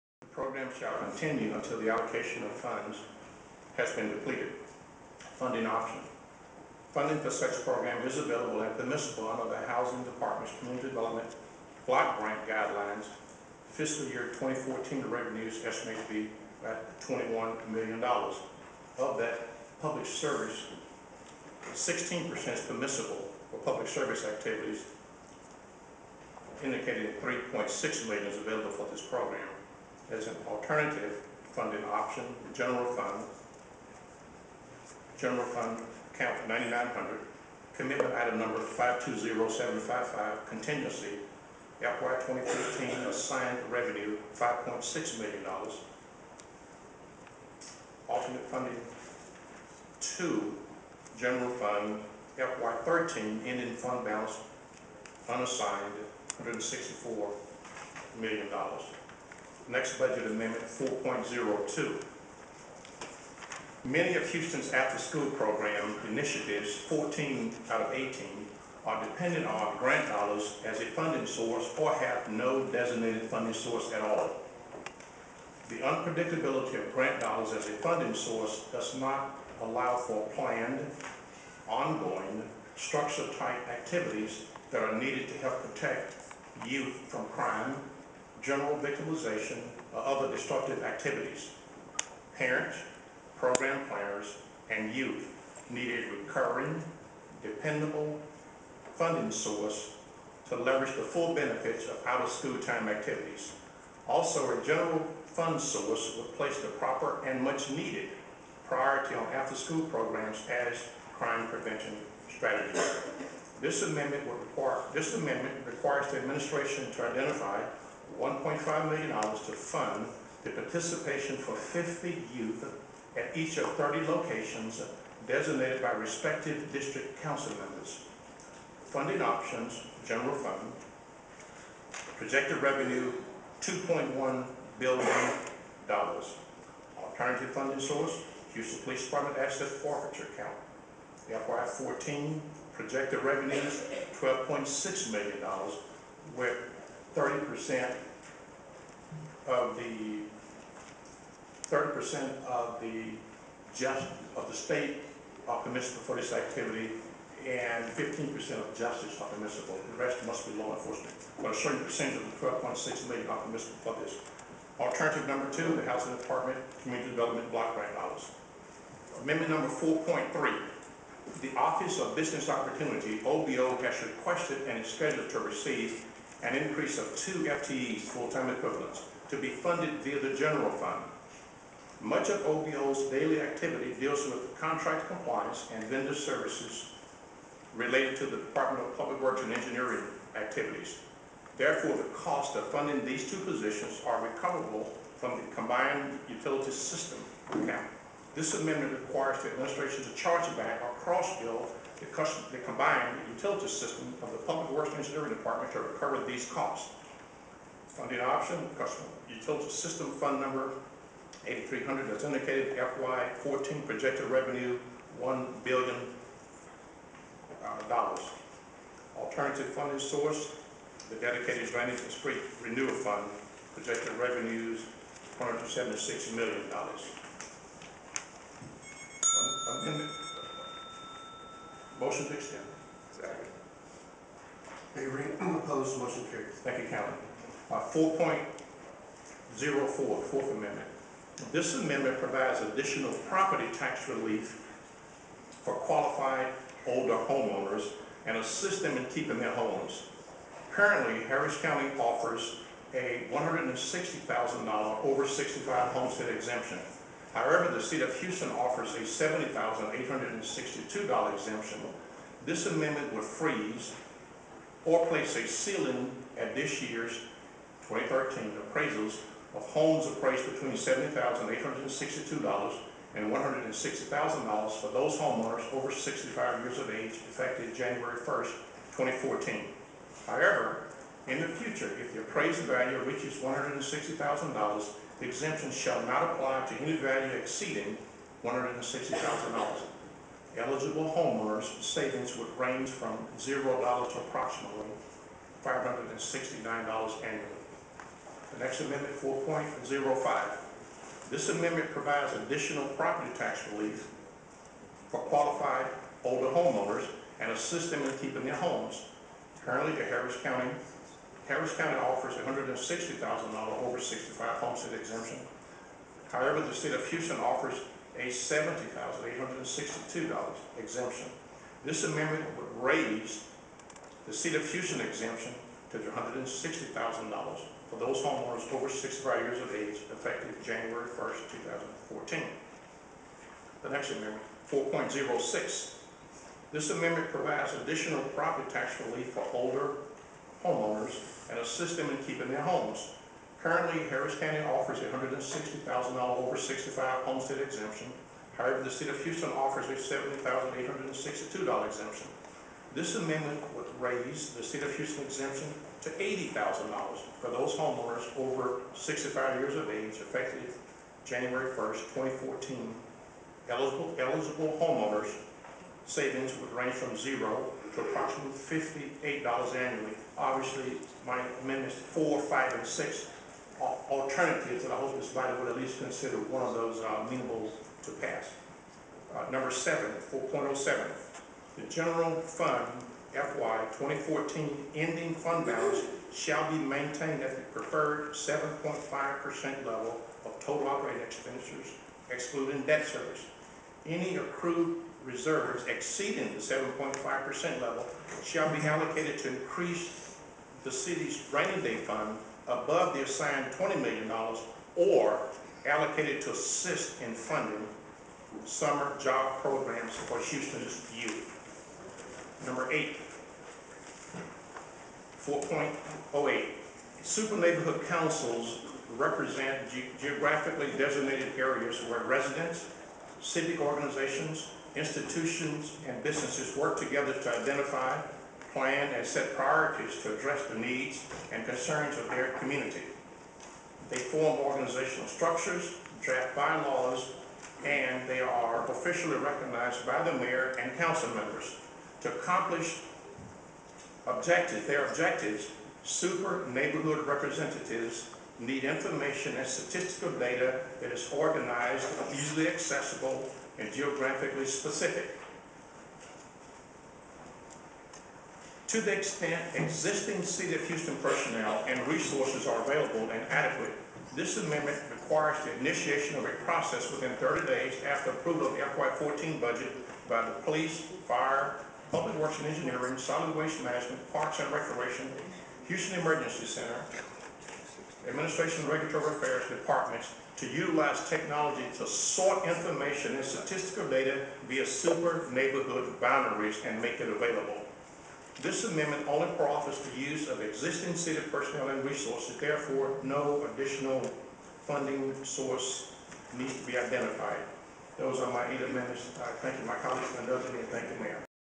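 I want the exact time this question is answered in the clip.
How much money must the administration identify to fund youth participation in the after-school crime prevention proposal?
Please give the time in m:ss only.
1:58.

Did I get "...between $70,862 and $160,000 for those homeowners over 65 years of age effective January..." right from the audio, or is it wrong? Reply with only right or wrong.
right.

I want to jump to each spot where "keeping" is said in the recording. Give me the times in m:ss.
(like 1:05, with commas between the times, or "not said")
4:09, 5:08, 5:42.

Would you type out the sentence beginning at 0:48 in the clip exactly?
Alternate funding two, general fund FY 13 ending fund balance unassigned $164 million.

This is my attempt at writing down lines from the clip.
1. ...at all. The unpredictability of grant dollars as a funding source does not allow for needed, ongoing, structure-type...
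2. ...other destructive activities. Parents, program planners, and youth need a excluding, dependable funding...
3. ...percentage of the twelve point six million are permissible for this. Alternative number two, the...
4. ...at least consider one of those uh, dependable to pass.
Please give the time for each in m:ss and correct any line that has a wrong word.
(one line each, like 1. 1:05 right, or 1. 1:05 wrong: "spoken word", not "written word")
1. 1:13 wrong: "planned", not "needed"
2. 1:30 wrong: "recurring", not "excluding"
3. 2:41 right
4. 6:15 wrong: "amenable", not "dependable".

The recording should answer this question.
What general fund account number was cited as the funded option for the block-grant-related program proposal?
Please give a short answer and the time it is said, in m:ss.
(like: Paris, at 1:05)
9900, at 0:35.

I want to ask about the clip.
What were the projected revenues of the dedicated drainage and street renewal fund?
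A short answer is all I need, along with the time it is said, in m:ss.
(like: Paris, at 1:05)
$176 million, at 3:45.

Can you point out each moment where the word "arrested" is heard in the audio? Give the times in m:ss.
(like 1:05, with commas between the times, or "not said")
not said.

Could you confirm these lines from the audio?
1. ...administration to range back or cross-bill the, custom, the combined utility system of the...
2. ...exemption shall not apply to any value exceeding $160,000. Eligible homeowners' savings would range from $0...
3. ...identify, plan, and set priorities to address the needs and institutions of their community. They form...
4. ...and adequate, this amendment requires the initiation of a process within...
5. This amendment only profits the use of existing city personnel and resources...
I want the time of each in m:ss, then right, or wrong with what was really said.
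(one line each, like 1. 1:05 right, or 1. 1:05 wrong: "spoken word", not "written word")
1. 3:19 wrong: "charge", not "range"
2. 4:45 right
3. 7:07 wrong: "concerns", not "institutions"
4. 7:43 right
5. 8:08 right.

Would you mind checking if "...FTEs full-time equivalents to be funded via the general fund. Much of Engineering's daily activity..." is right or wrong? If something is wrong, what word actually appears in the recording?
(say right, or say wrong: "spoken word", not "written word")
wrong: "OBO", not "Engineering".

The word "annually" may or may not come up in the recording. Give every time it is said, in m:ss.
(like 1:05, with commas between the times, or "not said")
4:57, 6:09.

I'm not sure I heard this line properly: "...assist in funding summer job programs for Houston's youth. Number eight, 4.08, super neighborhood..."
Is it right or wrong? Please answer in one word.
right.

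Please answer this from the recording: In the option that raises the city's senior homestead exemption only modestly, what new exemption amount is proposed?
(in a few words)
$80,000.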